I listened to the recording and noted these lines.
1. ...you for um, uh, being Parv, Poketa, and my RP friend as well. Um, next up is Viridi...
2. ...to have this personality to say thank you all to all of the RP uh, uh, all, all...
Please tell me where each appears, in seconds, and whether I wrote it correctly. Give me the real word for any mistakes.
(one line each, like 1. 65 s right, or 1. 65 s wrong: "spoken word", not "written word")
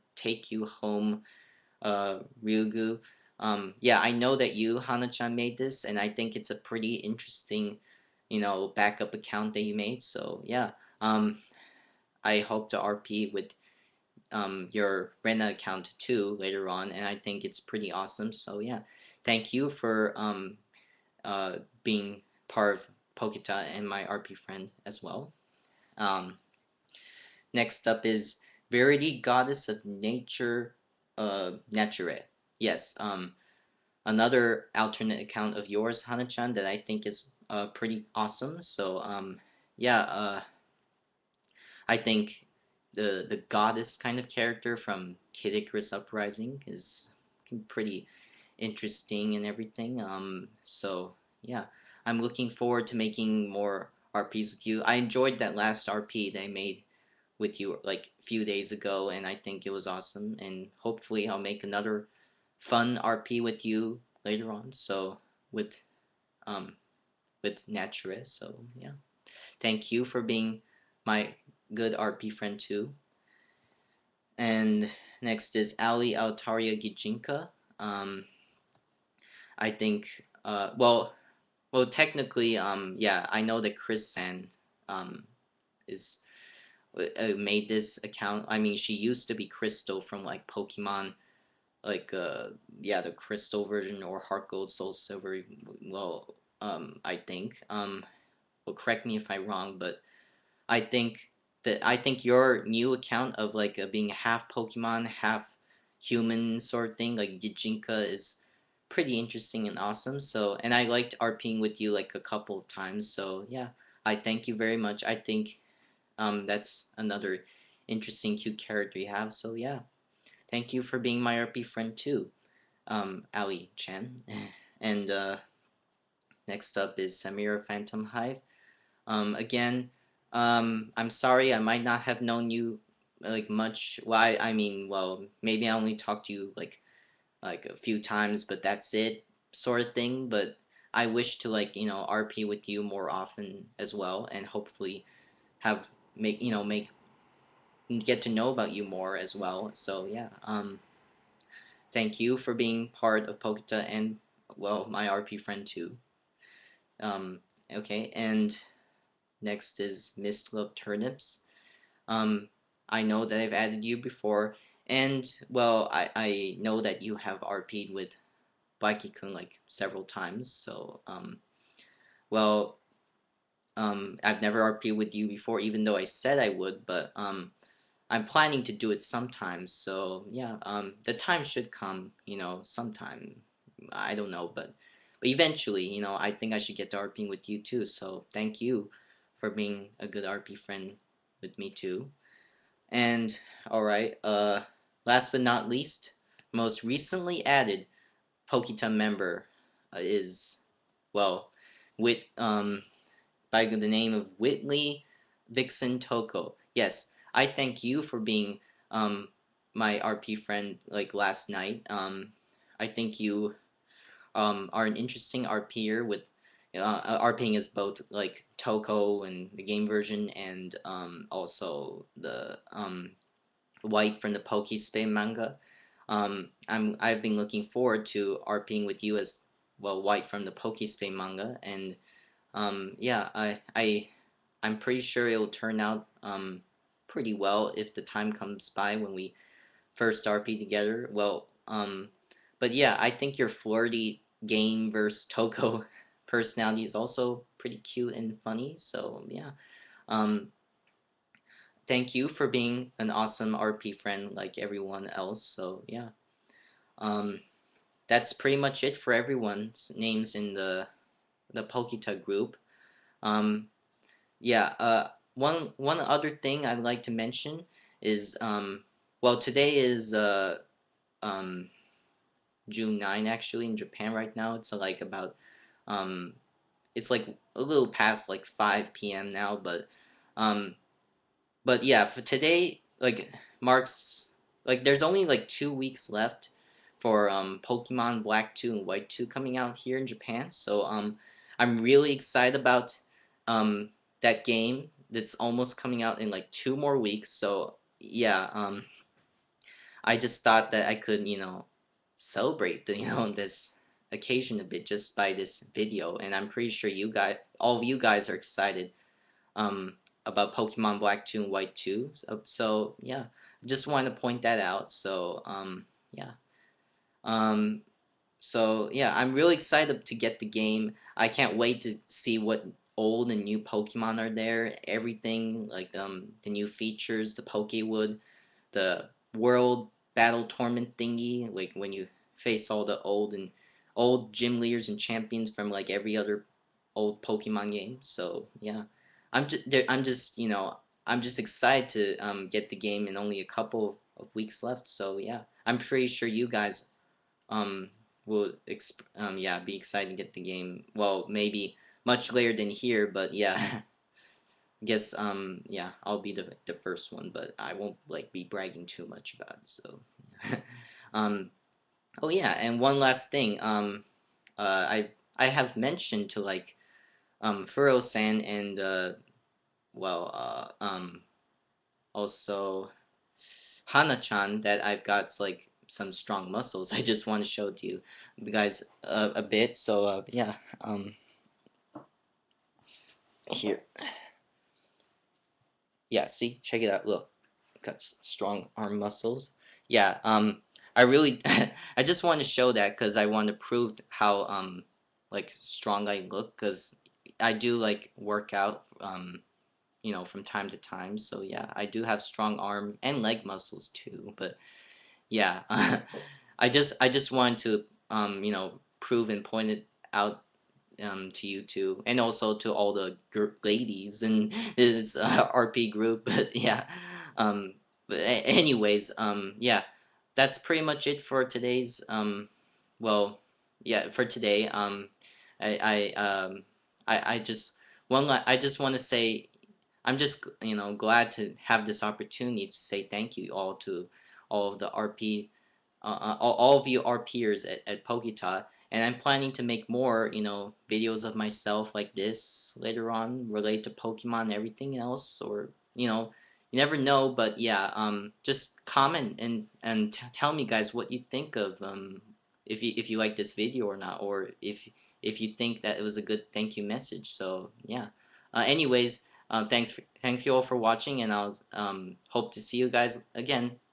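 1. 19 s right
2. 431 s wrong: "opportunity", not "personality".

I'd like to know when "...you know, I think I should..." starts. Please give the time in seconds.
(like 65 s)
185 s.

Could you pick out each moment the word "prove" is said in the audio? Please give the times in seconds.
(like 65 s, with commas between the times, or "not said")
393 s, 408 s.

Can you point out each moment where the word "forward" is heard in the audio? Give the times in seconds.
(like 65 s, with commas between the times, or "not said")
52 s, 227 s.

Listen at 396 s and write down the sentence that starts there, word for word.
Because I do like work out, um, you know, from time to time.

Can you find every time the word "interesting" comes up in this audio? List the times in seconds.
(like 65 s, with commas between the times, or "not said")
6 s, 48 s, 109 s, 117 s, 214 s.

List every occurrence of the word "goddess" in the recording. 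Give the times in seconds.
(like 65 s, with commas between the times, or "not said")
29 s, 43 s.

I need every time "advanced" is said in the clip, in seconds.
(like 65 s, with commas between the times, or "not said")
not said.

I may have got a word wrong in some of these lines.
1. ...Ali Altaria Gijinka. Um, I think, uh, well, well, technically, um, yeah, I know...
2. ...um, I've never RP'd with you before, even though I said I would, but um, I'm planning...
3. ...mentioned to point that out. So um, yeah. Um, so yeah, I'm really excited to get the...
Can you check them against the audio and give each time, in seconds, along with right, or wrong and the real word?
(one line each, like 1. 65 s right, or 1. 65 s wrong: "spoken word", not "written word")
1. 75 s right
2. 173 s right
3. 313 s wrong: "wanted", not "mentioned".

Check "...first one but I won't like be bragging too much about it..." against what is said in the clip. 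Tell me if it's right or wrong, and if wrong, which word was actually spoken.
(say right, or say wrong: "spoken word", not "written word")
right.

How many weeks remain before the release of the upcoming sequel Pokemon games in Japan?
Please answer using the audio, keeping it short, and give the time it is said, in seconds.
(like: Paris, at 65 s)
2, at 285 s.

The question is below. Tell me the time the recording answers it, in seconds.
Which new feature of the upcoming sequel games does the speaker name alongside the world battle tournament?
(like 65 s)
327 s.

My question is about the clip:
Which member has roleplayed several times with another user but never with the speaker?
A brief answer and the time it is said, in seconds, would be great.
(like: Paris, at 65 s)
Mist Love Turnips, at 160 s.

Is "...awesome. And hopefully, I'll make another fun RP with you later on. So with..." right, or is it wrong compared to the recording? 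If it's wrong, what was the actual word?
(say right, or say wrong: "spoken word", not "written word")
right.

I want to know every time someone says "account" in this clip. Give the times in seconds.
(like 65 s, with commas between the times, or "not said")
9 s, 15 s, 35 s, 88 s, 102 s.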